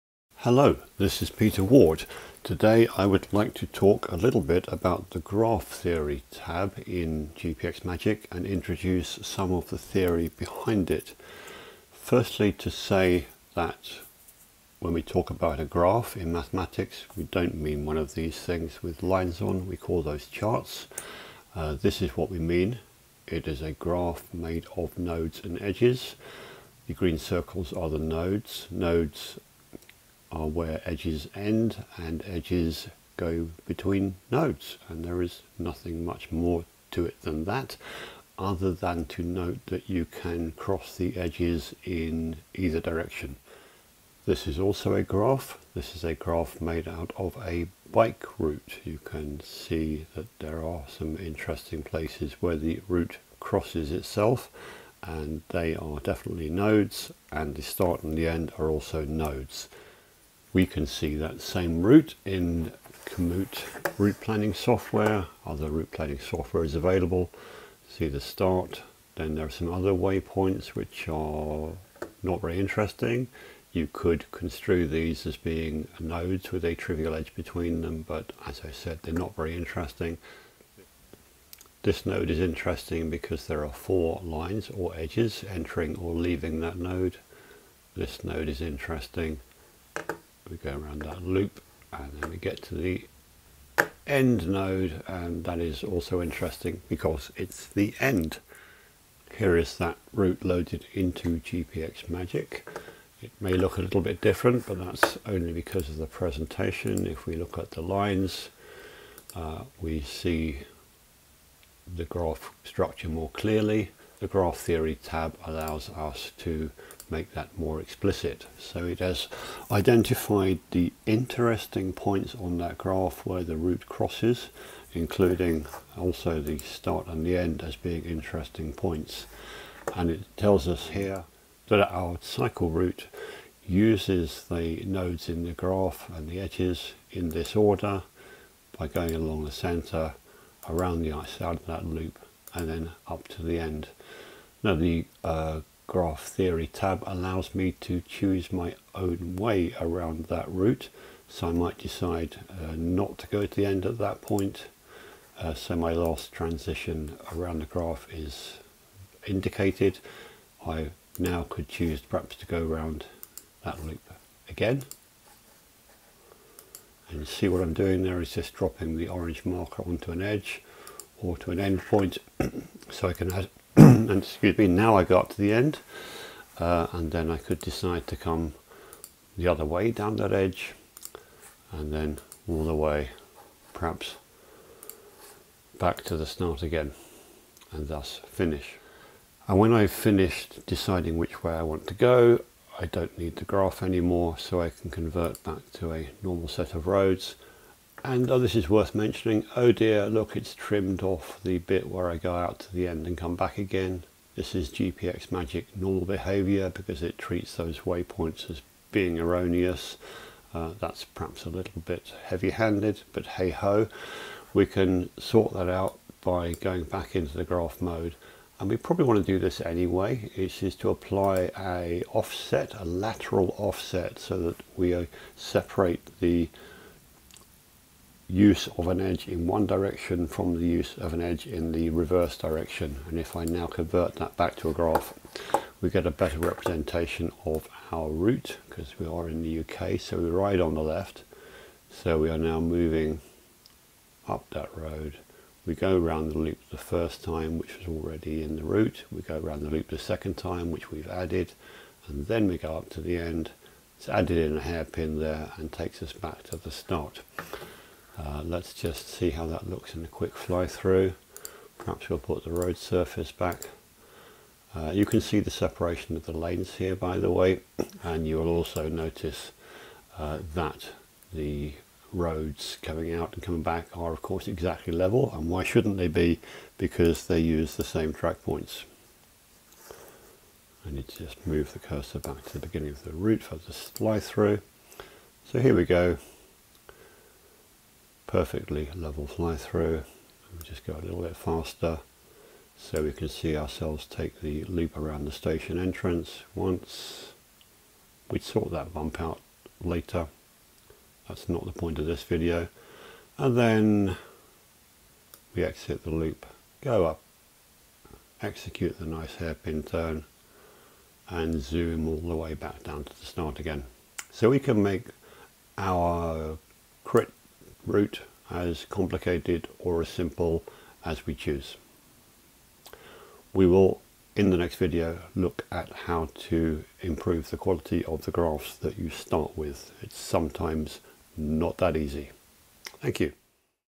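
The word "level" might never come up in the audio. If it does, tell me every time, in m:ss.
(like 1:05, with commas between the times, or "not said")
4:34, 4:48.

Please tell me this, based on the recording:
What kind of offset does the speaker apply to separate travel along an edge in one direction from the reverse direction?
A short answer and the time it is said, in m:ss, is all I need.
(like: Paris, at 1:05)
Lateral offset, at 3:42.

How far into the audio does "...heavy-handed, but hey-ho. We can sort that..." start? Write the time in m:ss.
3:32.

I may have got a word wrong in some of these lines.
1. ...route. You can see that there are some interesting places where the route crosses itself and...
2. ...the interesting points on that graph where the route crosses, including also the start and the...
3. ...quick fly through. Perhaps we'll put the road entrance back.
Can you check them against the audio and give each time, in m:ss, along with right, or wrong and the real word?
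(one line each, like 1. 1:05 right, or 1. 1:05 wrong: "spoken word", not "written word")
1. 0:48 right
2. 2:00 right
3. 4:20 wrong: "surface", not "entrance".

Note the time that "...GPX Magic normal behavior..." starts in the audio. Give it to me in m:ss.
3:24.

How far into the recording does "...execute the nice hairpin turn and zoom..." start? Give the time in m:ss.
5:08.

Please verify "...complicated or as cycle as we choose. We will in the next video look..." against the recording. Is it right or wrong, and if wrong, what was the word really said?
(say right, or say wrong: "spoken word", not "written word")
wrong: "simple", not "cycle".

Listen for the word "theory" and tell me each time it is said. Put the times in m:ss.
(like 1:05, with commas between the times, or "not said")
0:05, 0:09, 1:54, 2:26.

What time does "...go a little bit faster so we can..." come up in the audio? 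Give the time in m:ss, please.
4:50.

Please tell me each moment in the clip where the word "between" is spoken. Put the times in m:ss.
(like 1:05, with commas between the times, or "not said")
0:33, 1:17.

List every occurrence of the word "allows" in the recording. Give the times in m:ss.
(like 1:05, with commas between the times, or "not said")
1:55, 2:27.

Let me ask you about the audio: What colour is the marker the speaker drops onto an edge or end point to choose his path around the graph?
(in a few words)
Orange.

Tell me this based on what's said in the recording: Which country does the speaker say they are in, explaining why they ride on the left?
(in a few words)
UK.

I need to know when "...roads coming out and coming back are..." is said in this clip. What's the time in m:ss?
4:32.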